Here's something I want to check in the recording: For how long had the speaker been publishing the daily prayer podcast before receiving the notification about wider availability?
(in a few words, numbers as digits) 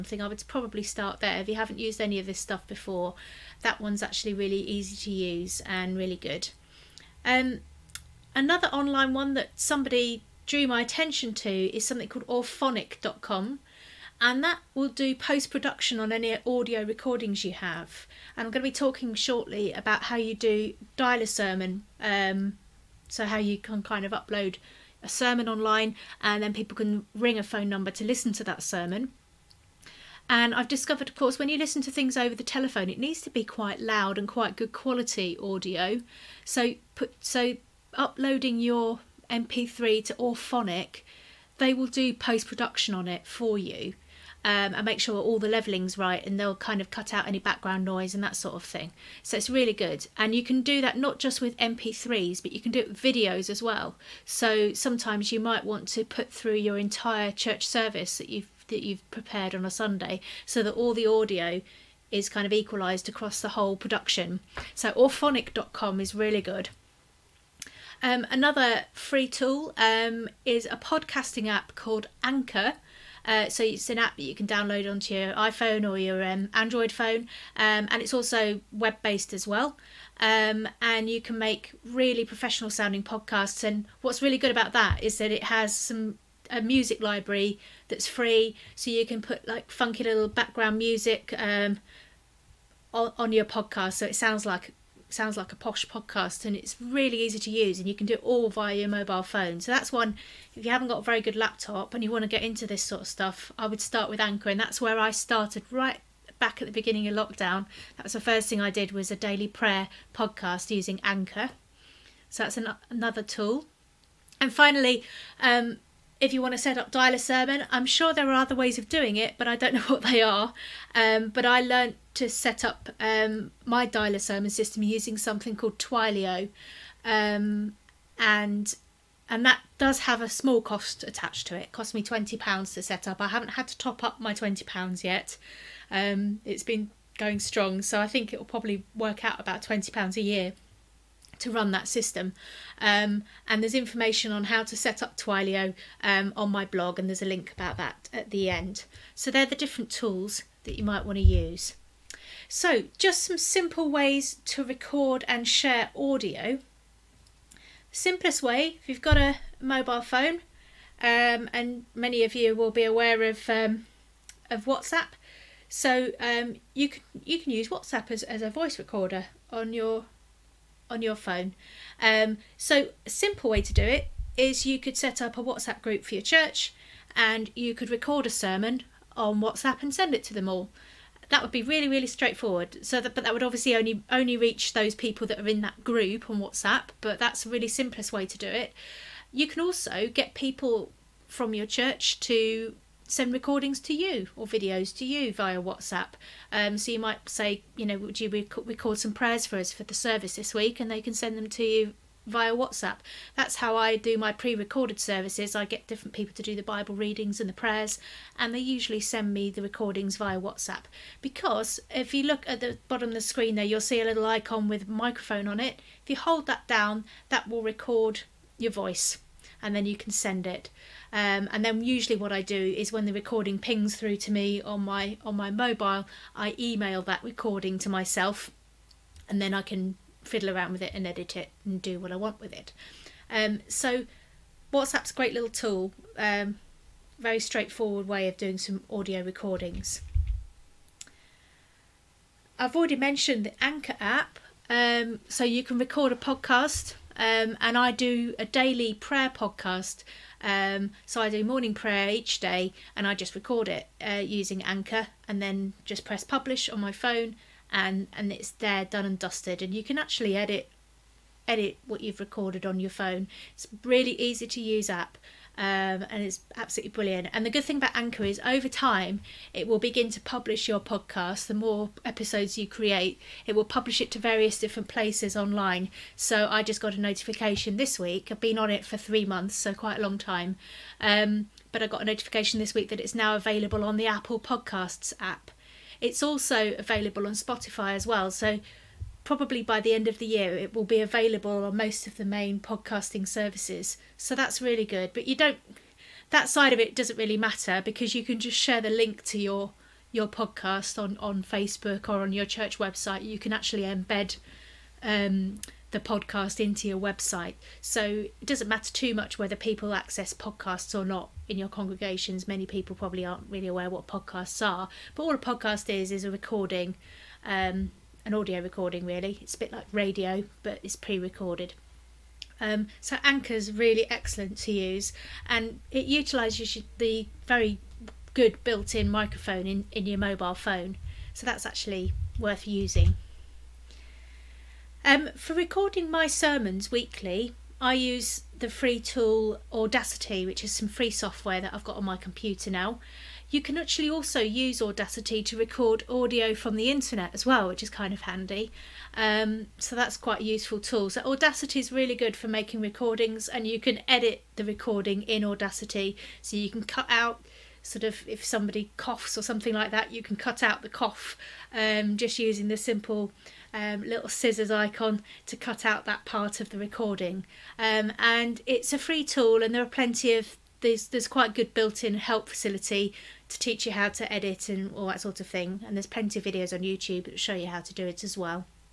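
3 months.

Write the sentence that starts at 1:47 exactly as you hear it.
That was the first thing I did was a daily prayer podcast using Anchor.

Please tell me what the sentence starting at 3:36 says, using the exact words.
If you hold that down, that will record your voice and then you can send it.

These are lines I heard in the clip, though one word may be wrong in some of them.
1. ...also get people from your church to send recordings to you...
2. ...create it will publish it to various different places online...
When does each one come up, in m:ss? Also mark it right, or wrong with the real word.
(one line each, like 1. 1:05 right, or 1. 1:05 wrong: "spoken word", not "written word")
1. 3:09 right
2. 4:32 right.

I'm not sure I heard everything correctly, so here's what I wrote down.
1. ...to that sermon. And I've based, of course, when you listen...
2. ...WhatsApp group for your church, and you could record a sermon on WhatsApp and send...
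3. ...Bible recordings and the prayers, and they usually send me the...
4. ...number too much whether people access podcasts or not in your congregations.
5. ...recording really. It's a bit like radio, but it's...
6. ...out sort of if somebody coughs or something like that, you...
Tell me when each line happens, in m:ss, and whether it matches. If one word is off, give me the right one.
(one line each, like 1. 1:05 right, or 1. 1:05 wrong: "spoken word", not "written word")
1. 0:28 wrong: "discovered", not "based"
2. 2:55 right
3. 3:26 wrong: "readings", not "recordings"
4. 5:08 wrong: "matter", not "number"
5. 5:18 right
6. 5:57 right.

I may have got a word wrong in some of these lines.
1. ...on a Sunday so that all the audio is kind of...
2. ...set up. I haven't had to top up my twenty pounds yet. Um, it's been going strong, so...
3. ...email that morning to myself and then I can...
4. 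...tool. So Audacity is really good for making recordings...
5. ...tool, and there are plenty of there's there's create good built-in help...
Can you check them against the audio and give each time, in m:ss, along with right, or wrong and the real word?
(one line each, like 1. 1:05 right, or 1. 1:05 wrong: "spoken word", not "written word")
1. 0:59 right
2. 2:12 right
3. 3:46 wrong: "recording", not "morning"
4. 5:50 right
5. 6:09 wrong: "quite", not "create".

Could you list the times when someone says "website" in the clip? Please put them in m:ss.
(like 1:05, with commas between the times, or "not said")
5:02, 5:06.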